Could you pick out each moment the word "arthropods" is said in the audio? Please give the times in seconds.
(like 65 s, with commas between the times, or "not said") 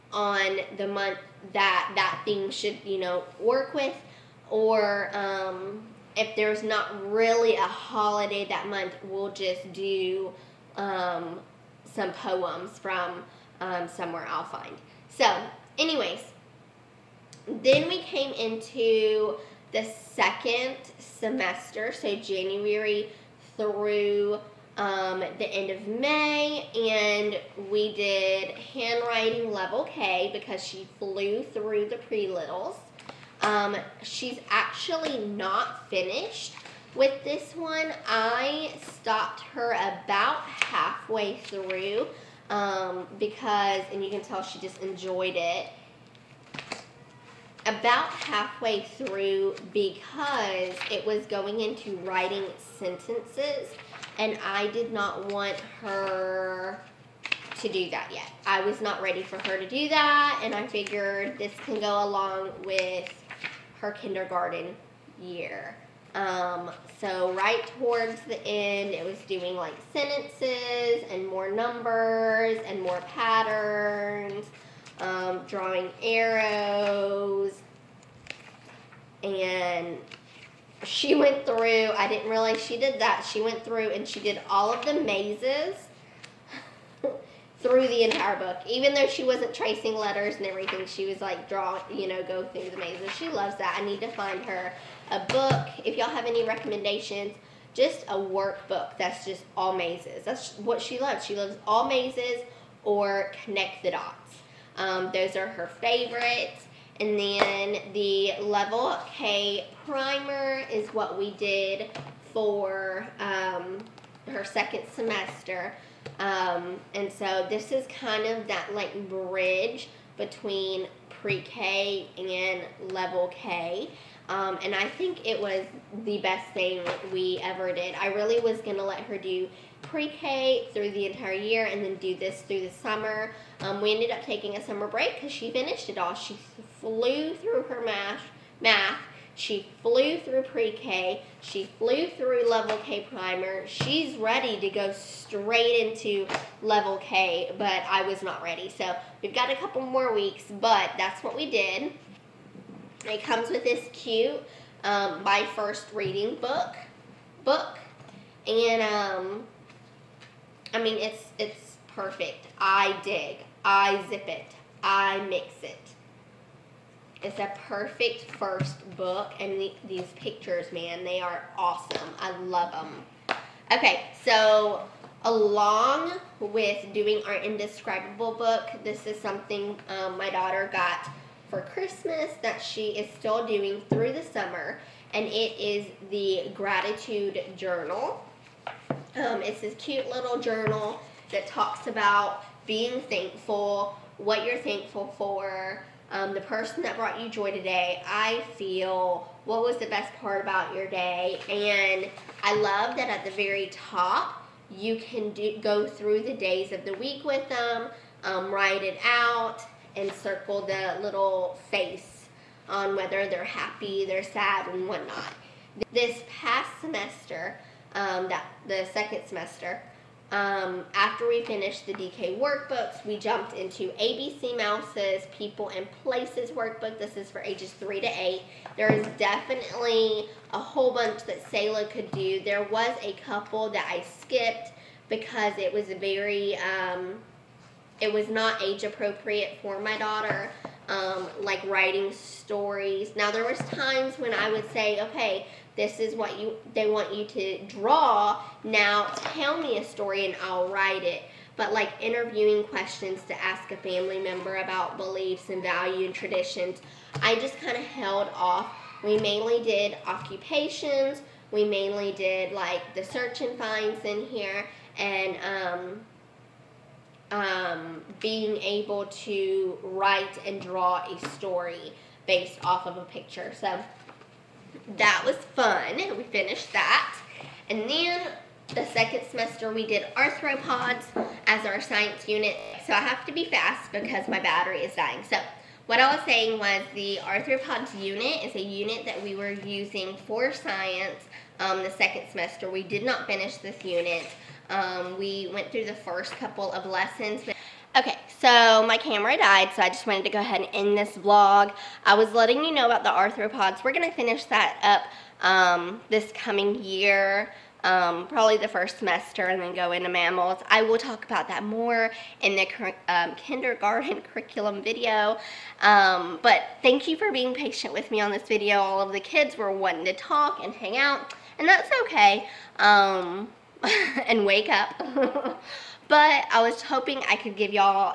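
280 s, 287 s, 303 s.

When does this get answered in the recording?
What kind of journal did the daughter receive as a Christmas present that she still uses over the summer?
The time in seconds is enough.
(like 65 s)
186 s.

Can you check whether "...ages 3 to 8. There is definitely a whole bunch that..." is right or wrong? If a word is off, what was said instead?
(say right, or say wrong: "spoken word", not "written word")
right.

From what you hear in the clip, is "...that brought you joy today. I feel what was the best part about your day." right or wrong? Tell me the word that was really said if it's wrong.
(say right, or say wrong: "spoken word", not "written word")
right.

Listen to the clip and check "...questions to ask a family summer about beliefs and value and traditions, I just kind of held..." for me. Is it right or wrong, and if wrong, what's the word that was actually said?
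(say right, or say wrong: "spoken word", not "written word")
wrong: "member", not "summer".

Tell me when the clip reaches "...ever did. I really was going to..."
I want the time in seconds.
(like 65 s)
127 s.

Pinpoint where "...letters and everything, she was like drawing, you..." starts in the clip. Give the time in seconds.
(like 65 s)
89 s.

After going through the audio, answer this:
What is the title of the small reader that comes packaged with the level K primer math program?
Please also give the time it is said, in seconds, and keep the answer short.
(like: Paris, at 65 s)
My First Reading book, at 155 s.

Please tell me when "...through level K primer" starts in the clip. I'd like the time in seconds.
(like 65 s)
142 s.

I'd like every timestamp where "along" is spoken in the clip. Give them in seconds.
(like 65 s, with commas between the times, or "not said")
62 s, 175 s.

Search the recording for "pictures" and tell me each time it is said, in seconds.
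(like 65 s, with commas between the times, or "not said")
170 s, 273 s.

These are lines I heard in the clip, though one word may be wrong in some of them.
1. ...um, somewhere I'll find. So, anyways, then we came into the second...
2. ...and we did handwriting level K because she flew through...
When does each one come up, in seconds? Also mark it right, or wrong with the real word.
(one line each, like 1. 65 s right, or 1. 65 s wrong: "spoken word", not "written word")
1. 13 s right
2. 26 s right.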